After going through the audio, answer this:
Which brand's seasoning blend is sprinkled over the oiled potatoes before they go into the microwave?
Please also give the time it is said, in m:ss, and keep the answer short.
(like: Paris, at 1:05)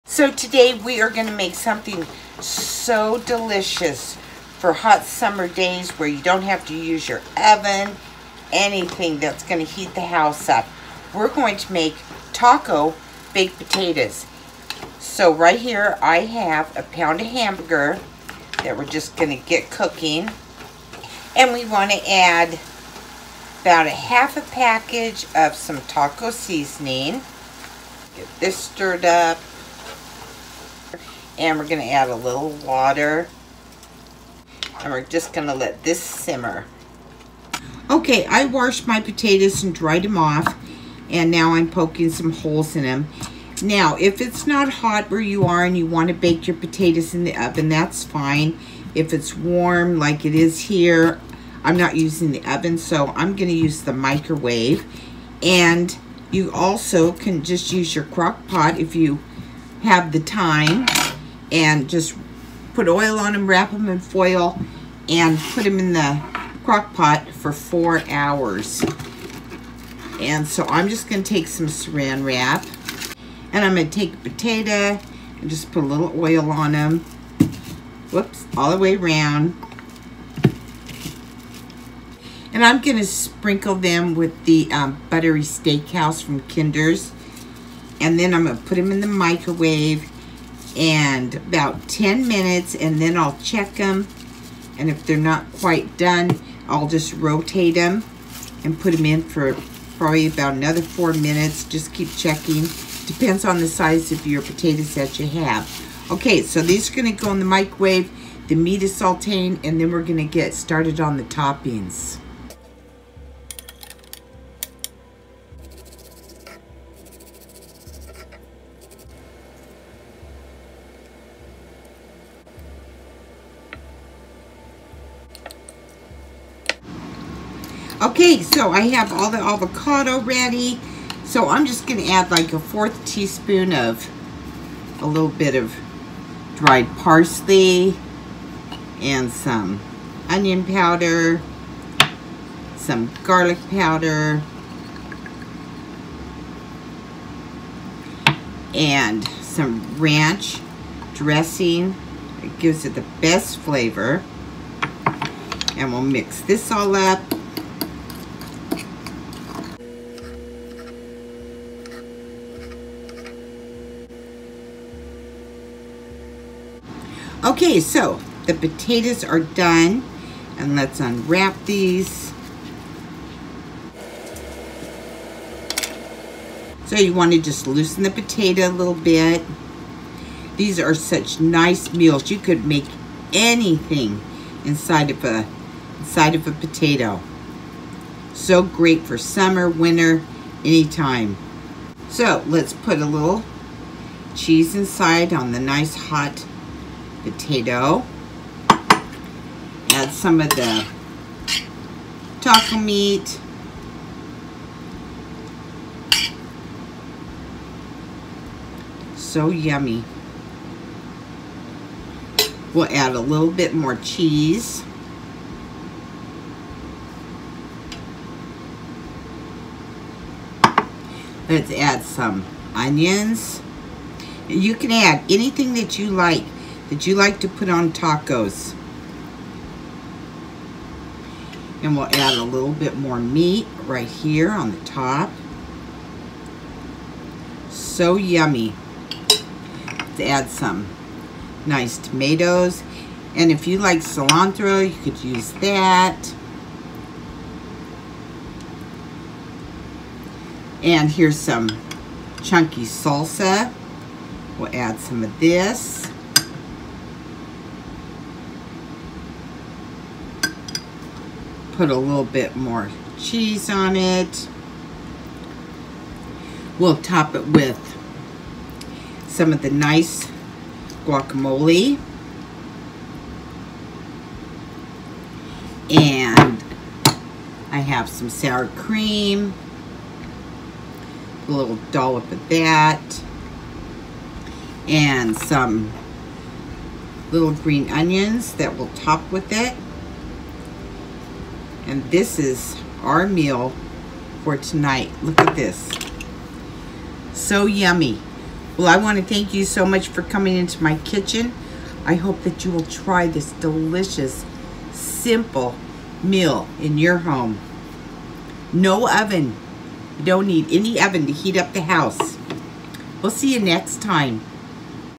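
Kinder's, at 1:26.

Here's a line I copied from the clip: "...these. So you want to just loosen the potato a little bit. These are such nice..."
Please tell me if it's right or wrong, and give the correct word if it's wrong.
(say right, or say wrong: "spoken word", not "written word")
right.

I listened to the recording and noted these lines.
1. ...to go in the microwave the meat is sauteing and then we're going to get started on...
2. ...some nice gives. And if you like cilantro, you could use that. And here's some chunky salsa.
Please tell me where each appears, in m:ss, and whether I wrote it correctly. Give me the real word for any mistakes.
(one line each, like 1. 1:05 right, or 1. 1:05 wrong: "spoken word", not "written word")
1. 1:47 right
2. 4:00 wrong: "tomatoes", not "gives".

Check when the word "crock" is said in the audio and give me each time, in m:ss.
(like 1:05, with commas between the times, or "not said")
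0:58, 1:06.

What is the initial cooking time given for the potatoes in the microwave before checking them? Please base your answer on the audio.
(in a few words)
10 minutes.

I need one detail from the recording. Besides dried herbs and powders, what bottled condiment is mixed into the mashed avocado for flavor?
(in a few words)
ranch dressing.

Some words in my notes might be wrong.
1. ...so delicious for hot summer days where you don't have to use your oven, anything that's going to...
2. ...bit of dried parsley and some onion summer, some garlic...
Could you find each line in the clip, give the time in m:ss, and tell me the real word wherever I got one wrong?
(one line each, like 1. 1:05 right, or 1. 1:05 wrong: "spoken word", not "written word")
1. 0:02 right
2. 2:15 wrong: "powder", not "summer".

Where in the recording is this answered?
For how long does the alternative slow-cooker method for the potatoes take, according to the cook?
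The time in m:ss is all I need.
1:07.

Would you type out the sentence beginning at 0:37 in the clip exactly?
Okay, I washed my potatoes and dried them off.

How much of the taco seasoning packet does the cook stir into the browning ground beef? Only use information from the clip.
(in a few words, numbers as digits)
half a package.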